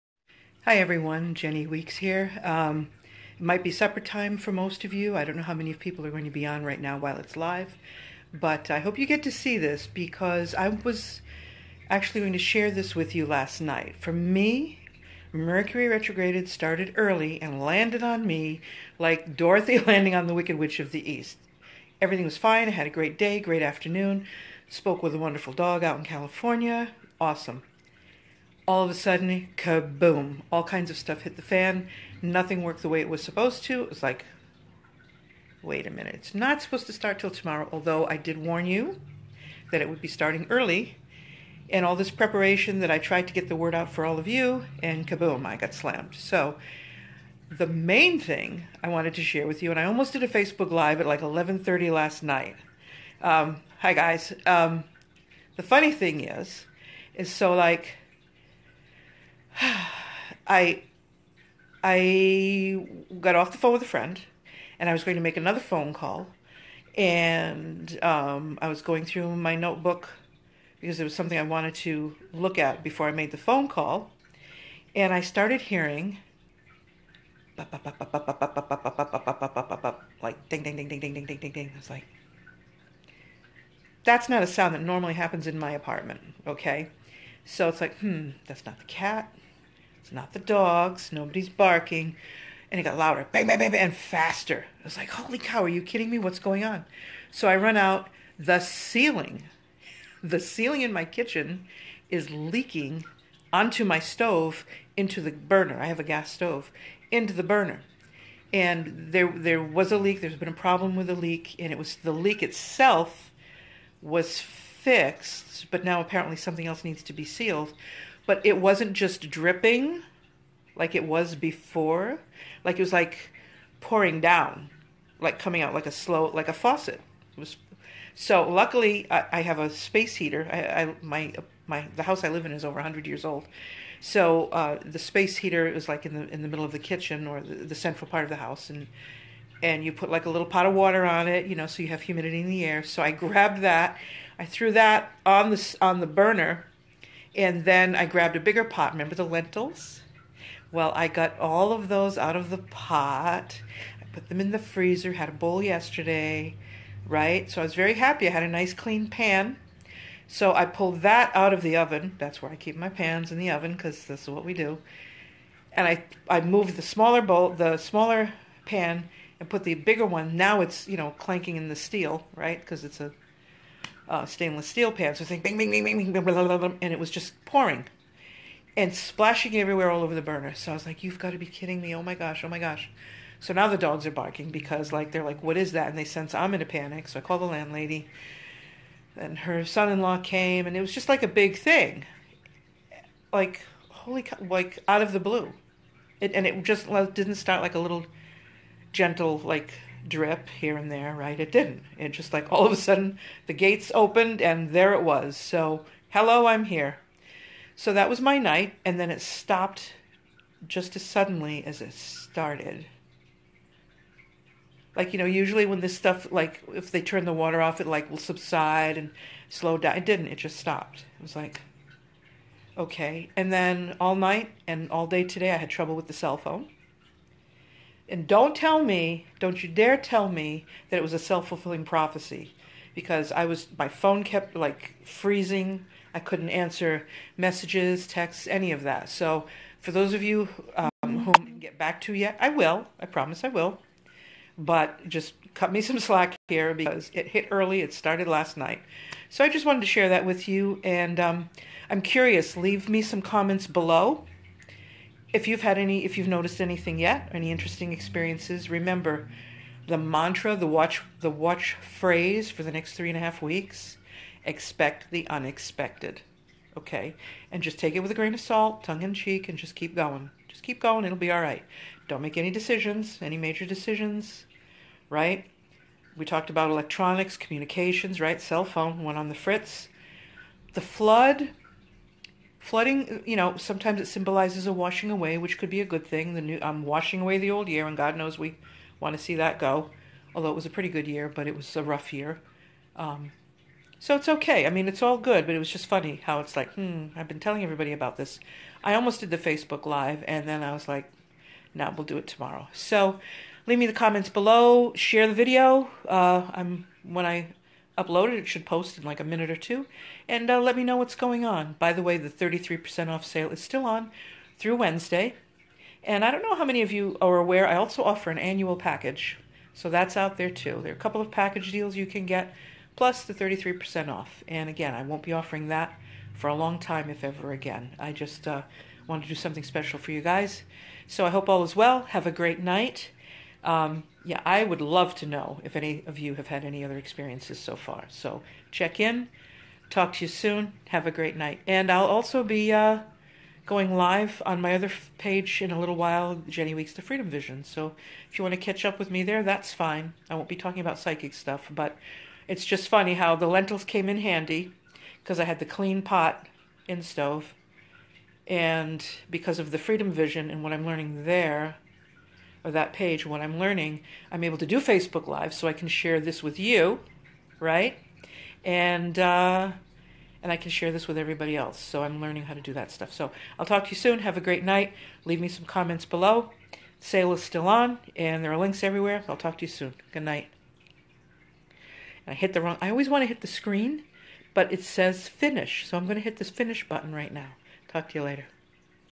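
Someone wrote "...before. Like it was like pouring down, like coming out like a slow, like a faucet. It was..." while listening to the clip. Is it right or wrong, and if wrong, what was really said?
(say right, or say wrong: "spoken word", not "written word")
right.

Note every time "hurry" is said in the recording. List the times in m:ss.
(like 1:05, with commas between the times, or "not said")
not said.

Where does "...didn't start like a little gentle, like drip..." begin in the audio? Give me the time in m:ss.
3:17.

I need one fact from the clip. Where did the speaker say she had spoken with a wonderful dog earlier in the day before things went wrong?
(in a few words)
California.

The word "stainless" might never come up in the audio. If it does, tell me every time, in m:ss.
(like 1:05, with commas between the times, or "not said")
2:54.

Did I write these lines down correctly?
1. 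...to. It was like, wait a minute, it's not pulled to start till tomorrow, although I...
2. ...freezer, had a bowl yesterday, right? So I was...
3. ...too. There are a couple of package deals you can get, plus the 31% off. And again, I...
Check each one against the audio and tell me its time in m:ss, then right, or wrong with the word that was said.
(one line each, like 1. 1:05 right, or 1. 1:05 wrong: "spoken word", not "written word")
1. 0:33 wrong: "supposed", not "pulled"
2. 2:34 right
3. 5:20 wrong: "33", not "31".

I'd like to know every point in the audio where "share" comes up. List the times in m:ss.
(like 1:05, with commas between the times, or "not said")
0:12, 0:49, 4:09, 5:04, 6:05, 6:10.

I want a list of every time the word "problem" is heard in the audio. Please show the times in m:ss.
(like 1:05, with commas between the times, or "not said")
1:50.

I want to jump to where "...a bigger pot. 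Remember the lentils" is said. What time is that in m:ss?
2:28.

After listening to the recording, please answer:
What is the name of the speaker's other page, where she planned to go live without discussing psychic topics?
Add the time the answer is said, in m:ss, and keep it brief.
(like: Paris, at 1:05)
Jenny Weeks the Freedom Vision, at 5:46.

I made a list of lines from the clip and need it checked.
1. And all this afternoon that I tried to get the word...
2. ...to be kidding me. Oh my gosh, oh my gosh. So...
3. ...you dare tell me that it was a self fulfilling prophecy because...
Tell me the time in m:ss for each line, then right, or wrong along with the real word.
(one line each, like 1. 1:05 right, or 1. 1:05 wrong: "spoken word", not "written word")
1. 0:41 wrong: "preparation", not "afternoon"
2. 3:01 right
3. 3:49 right.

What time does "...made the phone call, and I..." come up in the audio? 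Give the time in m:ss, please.
1:13.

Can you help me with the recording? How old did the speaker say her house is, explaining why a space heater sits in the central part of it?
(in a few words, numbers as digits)
Over 100 years.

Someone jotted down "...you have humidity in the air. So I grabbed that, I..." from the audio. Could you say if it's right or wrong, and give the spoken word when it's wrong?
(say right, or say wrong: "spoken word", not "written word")
right.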